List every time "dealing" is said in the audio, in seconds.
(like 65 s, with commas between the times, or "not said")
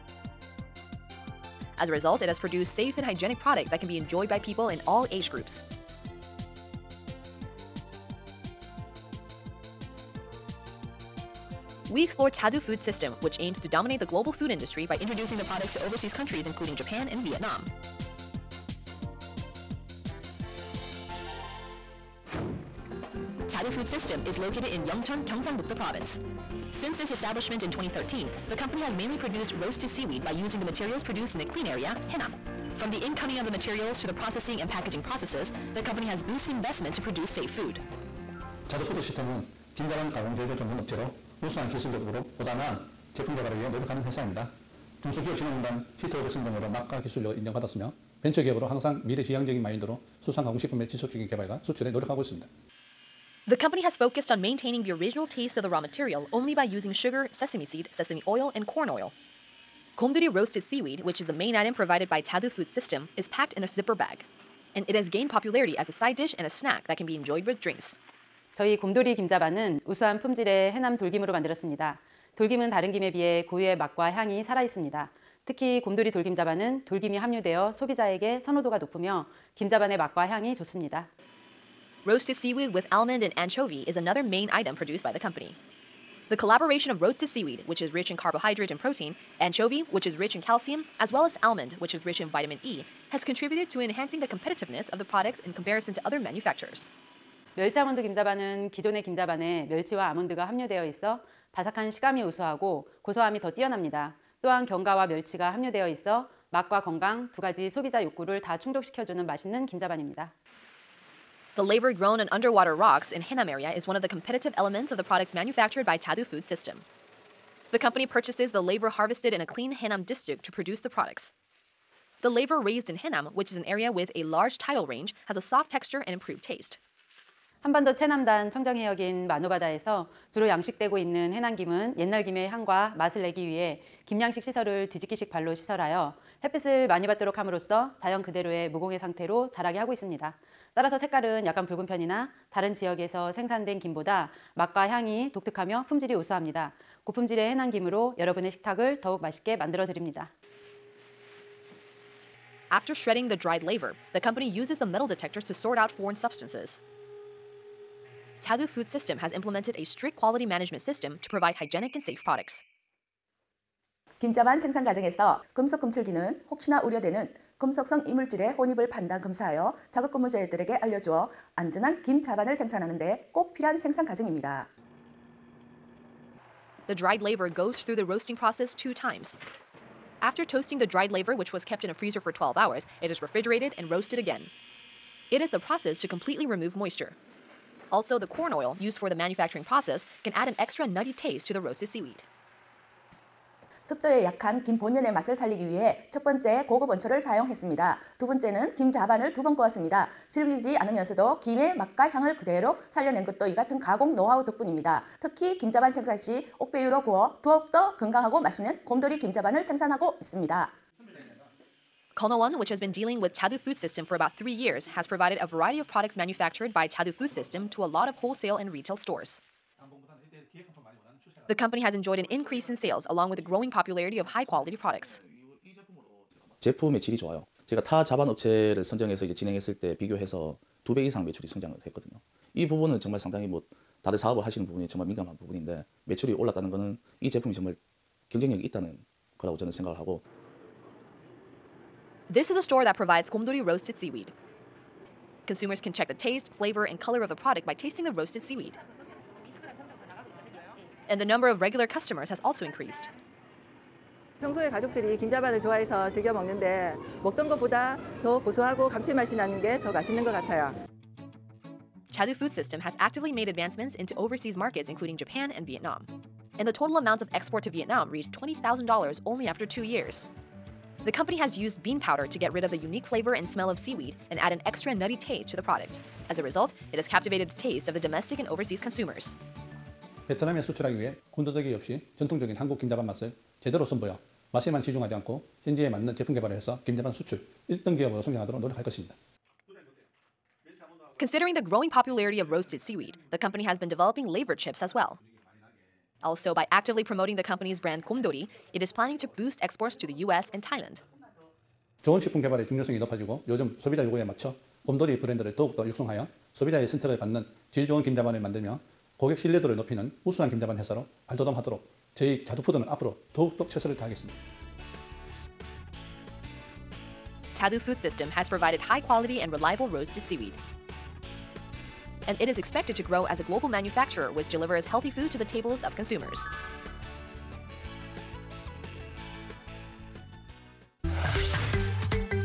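212 s.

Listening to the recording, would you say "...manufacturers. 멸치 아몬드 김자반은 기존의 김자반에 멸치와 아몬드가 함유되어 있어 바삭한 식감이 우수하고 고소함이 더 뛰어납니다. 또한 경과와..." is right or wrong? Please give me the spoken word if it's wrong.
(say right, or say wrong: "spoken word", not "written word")
right.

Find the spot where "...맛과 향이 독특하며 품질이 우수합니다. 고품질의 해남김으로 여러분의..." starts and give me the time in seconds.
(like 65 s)
144 s.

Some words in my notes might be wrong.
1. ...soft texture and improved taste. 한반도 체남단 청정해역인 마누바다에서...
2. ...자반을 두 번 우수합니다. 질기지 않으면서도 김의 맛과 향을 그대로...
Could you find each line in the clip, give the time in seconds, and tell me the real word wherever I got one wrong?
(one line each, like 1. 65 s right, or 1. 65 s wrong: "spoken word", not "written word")
1. 125 s right
2. 198 s wrong: "구웠습니다", not "우수합니다".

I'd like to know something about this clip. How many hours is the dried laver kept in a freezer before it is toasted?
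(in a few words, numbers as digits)
12 hours.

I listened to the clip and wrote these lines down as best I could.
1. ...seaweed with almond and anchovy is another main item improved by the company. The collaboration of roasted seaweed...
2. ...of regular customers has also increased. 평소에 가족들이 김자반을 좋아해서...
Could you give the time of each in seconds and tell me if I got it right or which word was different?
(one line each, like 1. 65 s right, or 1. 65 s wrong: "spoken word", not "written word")
1. 82 s wrong: "produced", not "improved"
2. 251 s right.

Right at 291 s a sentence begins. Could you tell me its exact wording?
Considering the growing popularity of roasted seaweed, The company has been developing labor chips as well.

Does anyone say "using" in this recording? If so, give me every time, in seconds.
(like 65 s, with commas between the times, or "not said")
30 s, 56 s.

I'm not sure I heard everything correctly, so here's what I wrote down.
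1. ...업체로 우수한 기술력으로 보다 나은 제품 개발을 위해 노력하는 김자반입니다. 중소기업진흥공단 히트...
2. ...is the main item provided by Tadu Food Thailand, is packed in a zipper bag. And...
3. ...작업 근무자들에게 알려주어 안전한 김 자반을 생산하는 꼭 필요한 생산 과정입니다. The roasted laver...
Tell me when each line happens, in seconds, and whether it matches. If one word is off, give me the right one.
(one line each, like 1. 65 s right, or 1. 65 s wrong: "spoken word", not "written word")
1. 40 s wrong: "회사입니다", not "김자반입니다"
2. 61 s wrong: "System", not "Thailand"
3. 169 s wrong: "dried", not "roasted".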